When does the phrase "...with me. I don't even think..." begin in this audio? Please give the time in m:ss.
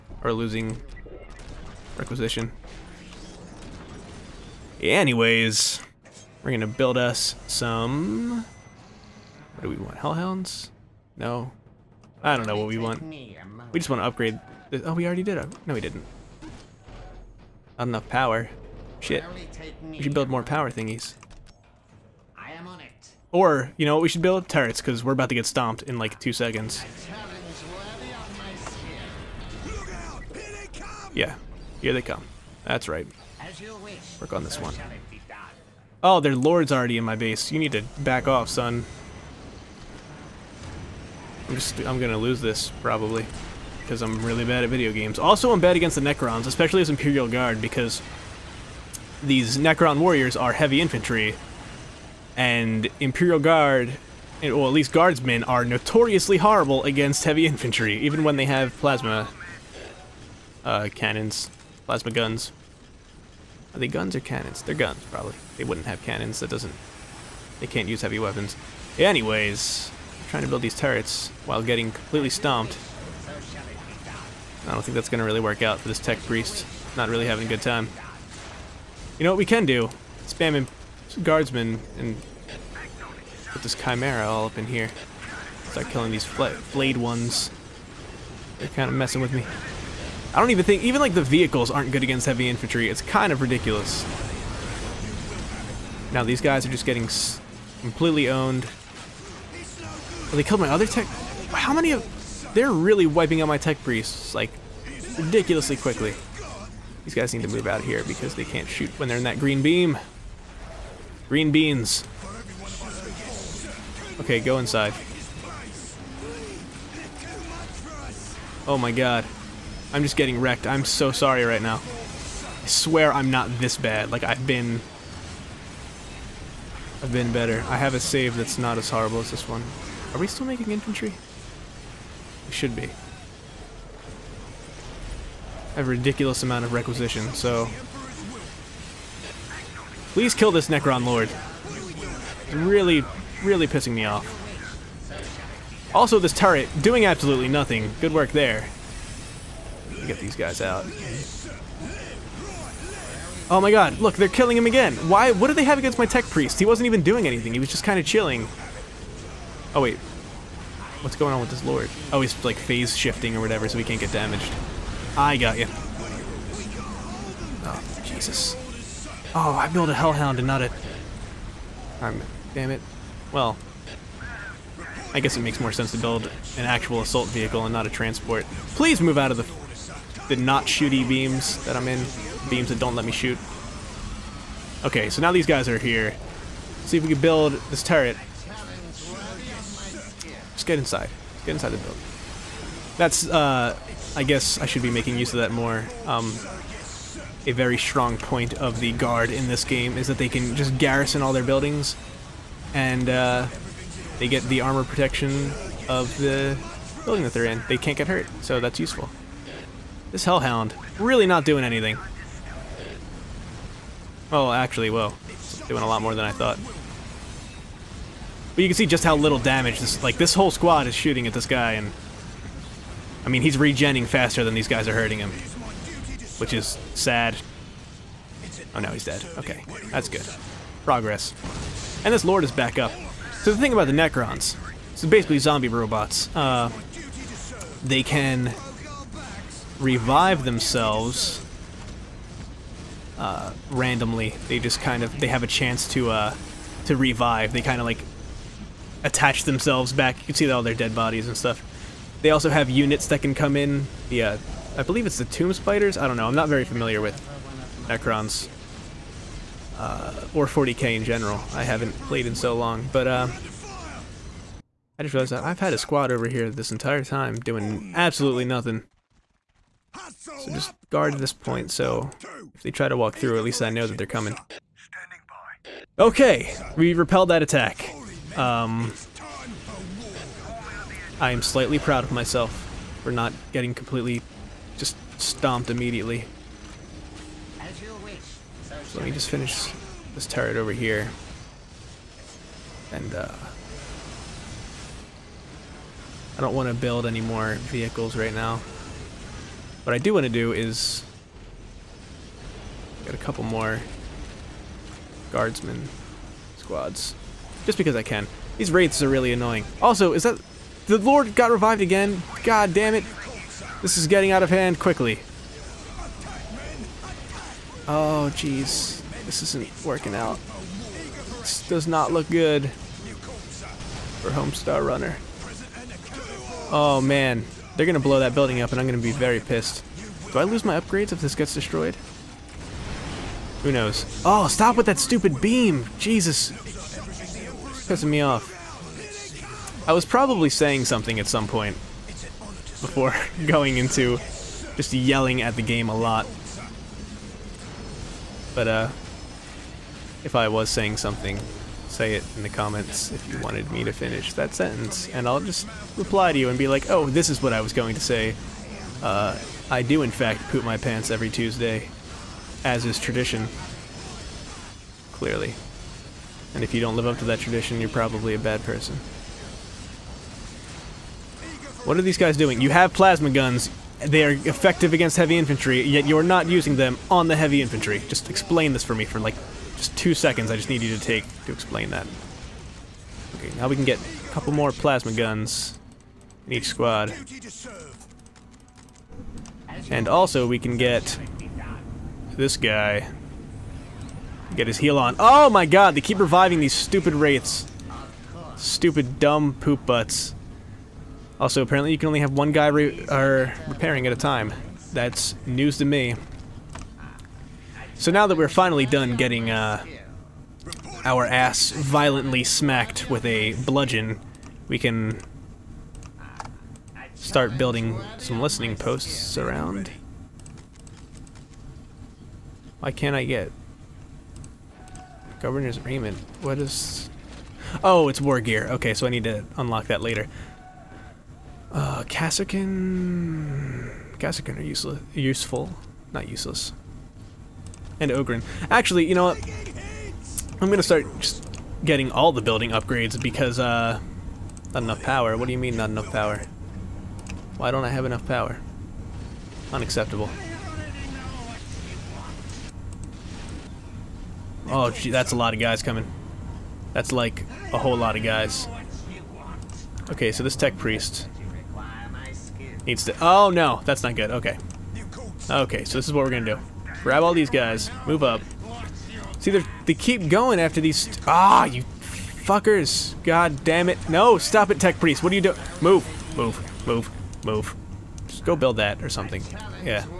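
1:29.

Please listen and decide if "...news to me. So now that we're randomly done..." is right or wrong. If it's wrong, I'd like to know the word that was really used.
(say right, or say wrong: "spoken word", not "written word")
wrong: "finally", not "randomly".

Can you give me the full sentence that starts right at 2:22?
It's really, really pissing me off.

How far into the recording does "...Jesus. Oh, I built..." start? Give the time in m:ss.
2:48.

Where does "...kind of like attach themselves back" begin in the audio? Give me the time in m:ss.
4:07.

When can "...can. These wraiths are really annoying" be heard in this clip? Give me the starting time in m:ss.
5:08.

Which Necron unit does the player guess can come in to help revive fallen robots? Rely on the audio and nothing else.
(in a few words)
Tomb Spiders.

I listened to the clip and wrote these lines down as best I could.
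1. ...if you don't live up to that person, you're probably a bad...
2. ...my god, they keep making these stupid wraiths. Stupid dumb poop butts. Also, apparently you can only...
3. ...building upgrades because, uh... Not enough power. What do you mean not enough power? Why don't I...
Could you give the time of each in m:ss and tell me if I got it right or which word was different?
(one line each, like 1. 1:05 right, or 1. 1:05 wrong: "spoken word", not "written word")
1. 6:06 wrong: "tradition", not "person"
2. 6:35 wrong: "reviving", not "making"
3. 7:22 right.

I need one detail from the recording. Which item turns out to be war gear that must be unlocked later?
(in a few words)
Governor's Agreement.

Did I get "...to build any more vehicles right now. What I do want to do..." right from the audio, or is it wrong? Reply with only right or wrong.
right.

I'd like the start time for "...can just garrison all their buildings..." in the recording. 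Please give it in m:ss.
3:20.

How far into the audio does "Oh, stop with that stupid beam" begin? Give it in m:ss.
5:34.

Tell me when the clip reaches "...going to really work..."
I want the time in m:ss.
1:15.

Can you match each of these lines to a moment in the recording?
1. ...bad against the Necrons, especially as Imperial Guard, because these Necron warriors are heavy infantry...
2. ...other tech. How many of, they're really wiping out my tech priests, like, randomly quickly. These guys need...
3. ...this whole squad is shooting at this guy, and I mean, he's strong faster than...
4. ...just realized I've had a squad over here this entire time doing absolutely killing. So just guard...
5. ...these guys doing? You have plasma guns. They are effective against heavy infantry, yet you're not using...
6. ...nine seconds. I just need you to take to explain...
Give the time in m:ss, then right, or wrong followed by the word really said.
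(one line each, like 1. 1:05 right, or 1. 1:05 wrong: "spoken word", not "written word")
1. 0:45 right
2. 1:40 wrong: "ridiculously", not "randomly"
3. 3:40 wrong: "regenning", not "strong"
4. 4:25 wrong: "nothing", not "killing"
5. 6:12 right
6. 6:19 wrong: "two", not "nine".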